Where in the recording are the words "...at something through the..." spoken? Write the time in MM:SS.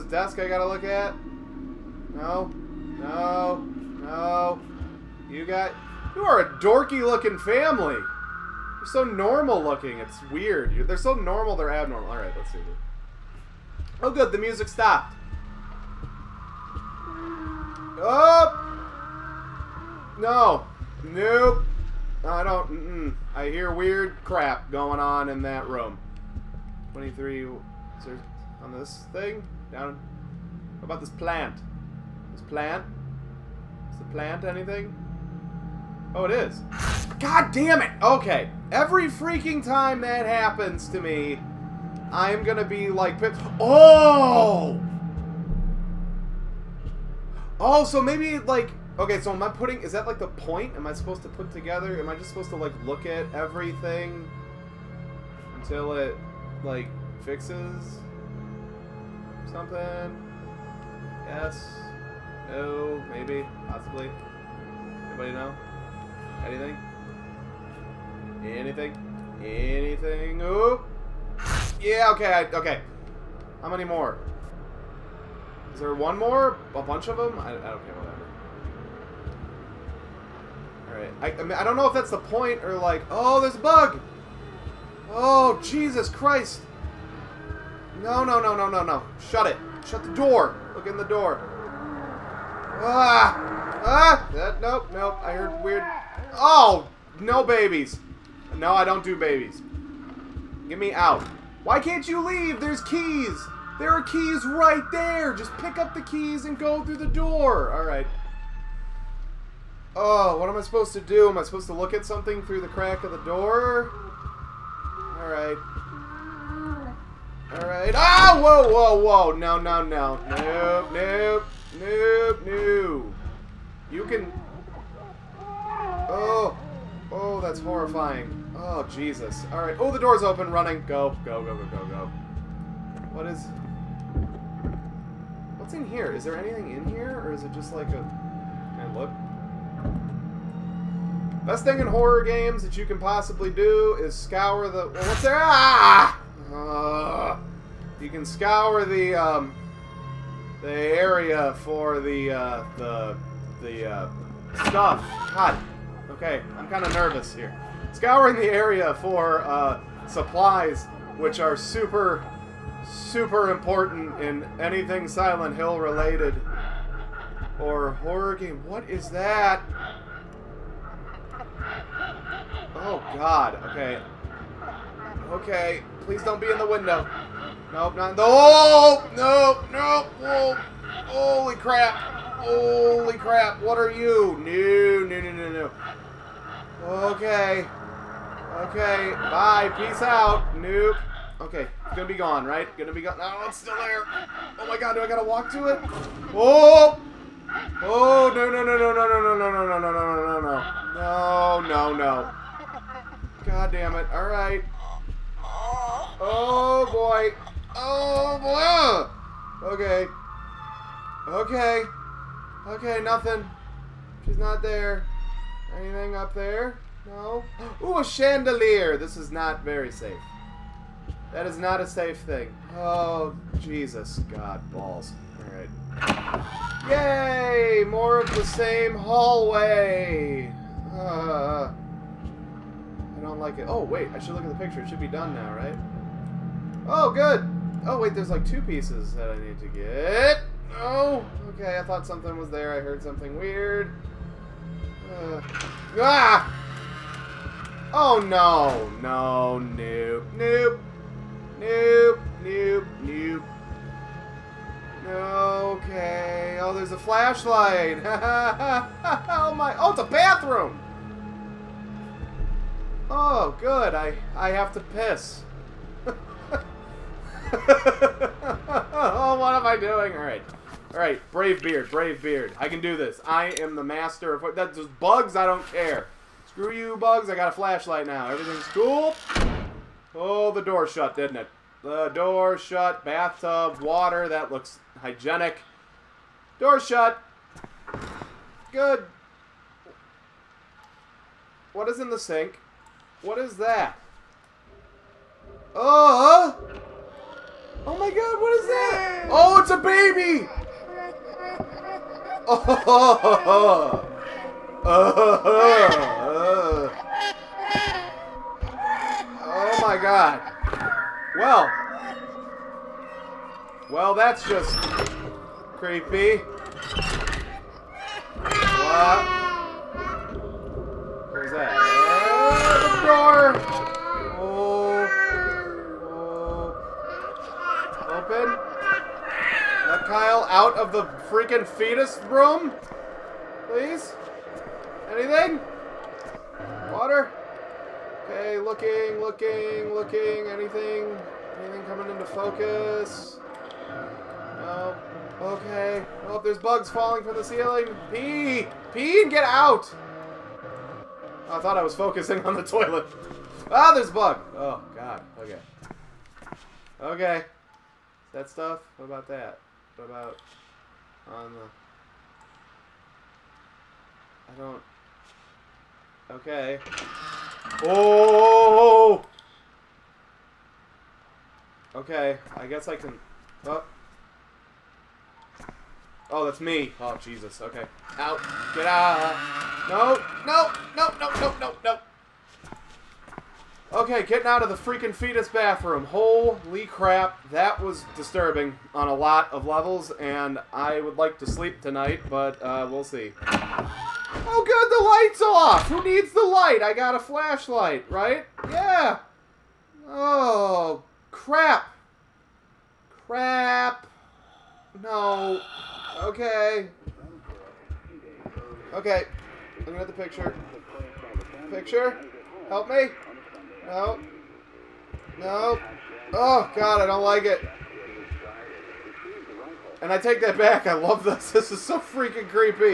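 01:51.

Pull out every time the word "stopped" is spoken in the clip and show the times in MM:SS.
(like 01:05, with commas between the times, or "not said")
00:14.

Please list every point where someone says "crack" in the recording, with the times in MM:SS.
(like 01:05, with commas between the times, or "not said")
01:52.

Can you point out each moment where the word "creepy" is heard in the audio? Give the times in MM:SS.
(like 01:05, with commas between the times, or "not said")
05:15.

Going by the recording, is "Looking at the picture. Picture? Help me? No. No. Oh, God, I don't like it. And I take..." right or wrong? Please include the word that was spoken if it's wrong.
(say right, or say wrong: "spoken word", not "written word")
right.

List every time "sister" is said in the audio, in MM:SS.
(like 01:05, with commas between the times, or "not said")
not said.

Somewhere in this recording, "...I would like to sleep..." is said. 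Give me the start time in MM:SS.
06:30.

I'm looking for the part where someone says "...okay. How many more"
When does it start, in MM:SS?
01:12.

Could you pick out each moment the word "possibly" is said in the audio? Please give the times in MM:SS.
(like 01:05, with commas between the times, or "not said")
01:03, 02:22.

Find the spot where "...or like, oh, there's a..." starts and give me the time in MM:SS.
01:22.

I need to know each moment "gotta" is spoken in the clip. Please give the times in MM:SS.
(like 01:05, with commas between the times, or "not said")
00:00, 03:15.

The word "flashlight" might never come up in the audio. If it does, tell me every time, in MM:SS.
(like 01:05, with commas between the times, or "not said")
04:16, 04:37, 06:37.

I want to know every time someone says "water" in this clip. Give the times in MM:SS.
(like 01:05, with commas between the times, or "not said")
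04:43, 05:36.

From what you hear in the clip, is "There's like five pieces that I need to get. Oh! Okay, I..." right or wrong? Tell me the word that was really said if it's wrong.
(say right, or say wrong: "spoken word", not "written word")
wrong: "two", not "five".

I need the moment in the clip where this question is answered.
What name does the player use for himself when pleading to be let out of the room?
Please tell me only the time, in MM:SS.
05:30.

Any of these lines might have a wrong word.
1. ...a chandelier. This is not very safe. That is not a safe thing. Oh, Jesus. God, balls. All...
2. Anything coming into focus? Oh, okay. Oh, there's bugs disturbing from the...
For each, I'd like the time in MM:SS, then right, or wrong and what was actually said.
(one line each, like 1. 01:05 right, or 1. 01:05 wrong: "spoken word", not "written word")
1. 03:37 right
2. 05:41 wrong: "falling", not "disturbing".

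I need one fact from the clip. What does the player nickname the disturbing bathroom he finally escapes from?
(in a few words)
Fetus bathroom.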